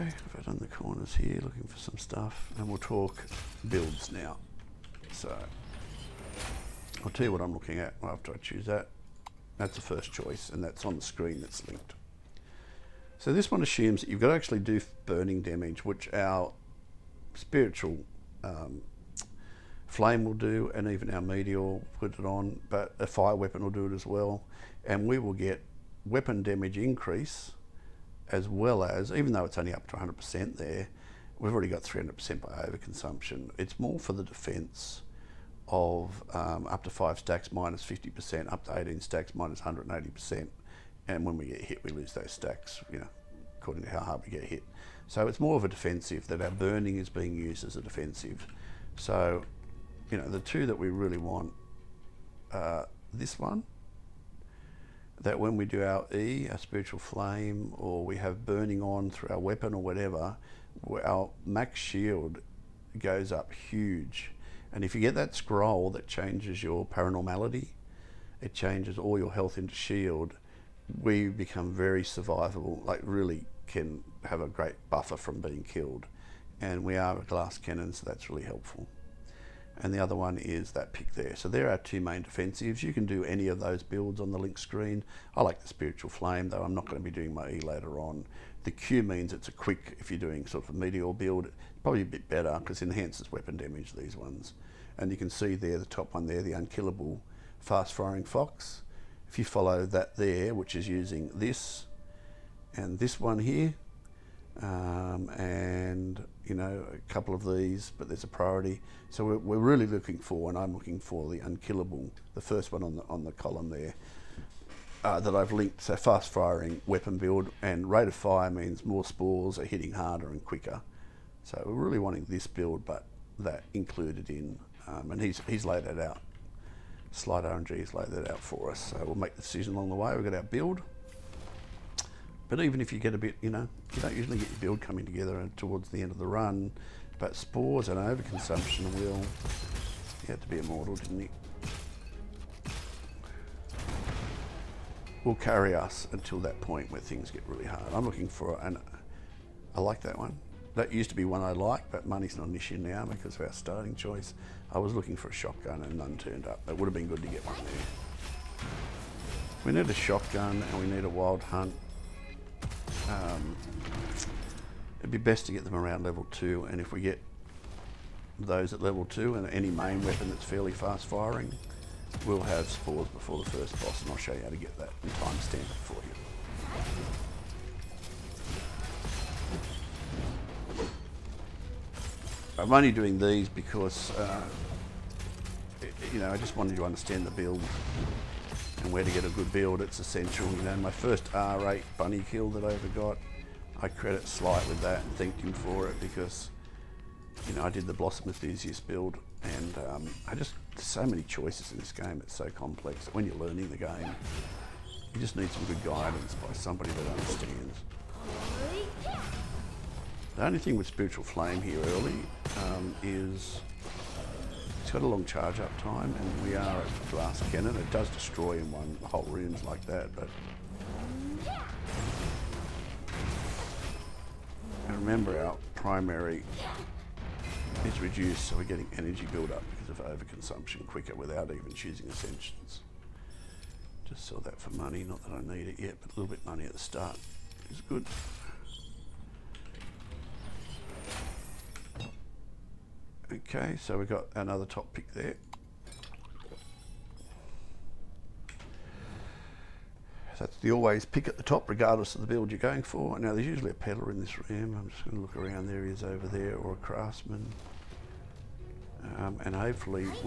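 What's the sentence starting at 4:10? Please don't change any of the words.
That's the always pick at the top, regardless of the build you're going for.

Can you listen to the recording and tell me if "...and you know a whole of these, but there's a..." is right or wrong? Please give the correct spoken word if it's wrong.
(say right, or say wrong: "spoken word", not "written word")
wrong: "couple", not "whole".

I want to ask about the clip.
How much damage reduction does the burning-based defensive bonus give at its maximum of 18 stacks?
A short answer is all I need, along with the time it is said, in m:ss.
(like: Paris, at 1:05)
180%, at 0:39.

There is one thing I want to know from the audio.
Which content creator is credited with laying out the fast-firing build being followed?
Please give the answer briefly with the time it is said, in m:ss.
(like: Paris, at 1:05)
Slide RNG, at 2:07.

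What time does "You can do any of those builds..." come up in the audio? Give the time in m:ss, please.
1:22.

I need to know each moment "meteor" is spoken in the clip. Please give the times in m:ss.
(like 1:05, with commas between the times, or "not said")
0:21, 1:30.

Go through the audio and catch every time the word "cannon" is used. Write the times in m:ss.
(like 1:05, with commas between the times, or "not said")
1:17, 3:37.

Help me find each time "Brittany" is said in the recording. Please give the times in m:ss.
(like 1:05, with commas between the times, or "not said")
not said.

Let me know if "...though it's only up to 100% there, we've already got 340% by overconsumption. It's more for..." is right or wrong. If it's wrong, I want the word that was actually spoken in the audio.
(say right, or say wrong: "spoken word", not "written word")
wrong: "300", not "340".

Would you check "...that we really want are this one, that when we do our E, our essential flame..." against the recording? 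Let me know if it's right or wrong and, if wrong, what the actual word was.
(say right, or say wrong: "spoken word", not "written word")
wrong: "spiritual", not "essential".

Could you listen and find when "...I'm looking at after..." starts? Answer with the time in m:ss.
0:07.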